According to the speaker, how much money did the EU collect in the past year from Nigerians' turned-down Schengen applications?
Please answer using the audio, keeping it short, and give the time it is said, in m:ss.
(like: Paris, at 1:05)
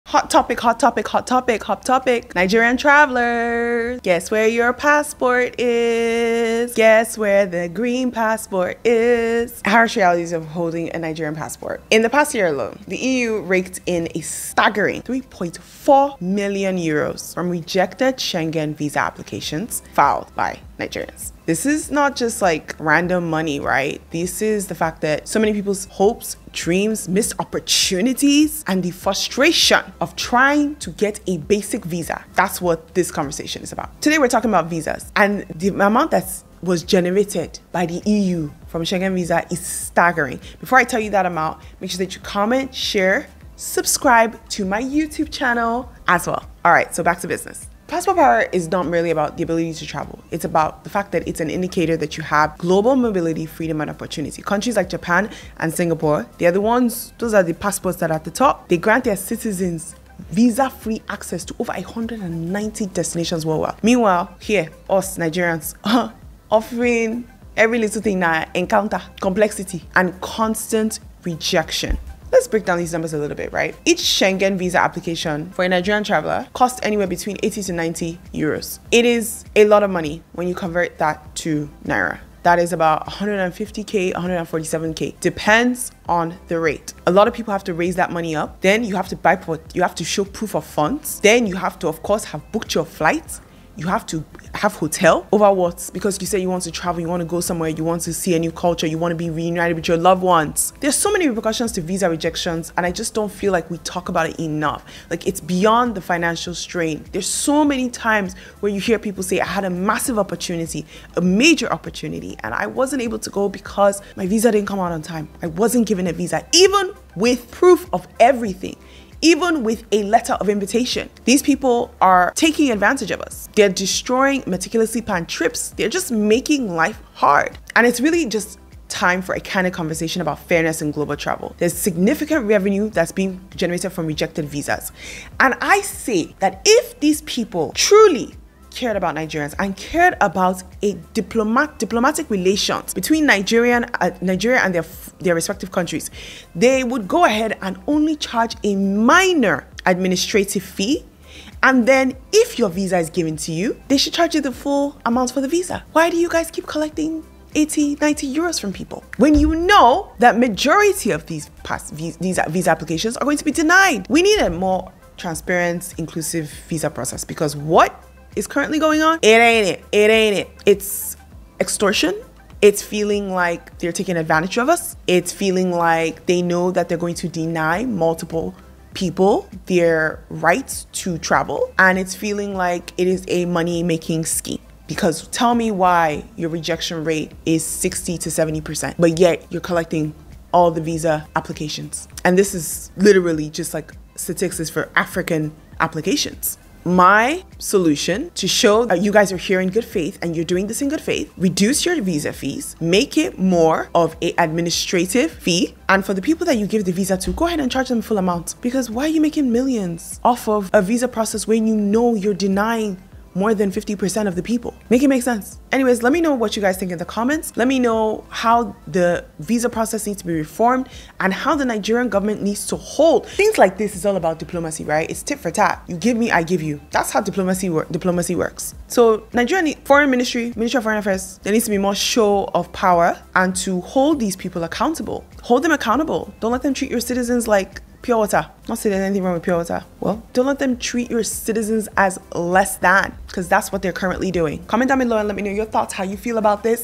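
3.4 million euros, at 0:15.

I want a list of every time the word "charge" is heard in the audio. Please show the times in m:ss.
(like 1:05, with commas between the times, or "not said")
2:28, 2:34, 3:27.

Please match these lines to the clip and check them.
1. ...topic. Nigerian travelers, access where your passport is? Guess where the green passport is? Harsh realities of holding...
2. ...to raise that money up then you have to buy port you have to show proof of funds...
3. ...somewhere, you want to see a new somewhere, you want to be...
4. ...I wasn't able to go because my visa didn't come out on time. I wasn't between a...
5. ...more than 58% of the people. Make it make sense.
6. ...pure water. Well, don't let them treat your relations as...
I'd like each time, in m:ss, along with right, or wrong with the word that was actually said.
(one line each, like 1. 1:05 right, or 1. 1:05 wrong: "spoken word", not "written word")
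1. 0:01 wrong: "guess", not "access"
2. 1:27 right
3. 1:37 wrong: "culture", not "somewhere"
4. 1:52 wrong: "given", not "between"
5. 3:33 wrong: "50", not "58"
6. 3:59 wrong: "citizens", not "relations".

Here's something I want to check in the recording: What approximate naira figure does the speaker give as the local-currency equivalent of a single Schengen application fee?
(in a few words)
147k.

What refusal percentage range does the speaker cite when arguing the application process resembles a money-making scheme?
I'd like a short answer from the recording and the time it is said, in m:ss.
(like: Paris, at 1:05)
60 to 70%, at 3:07.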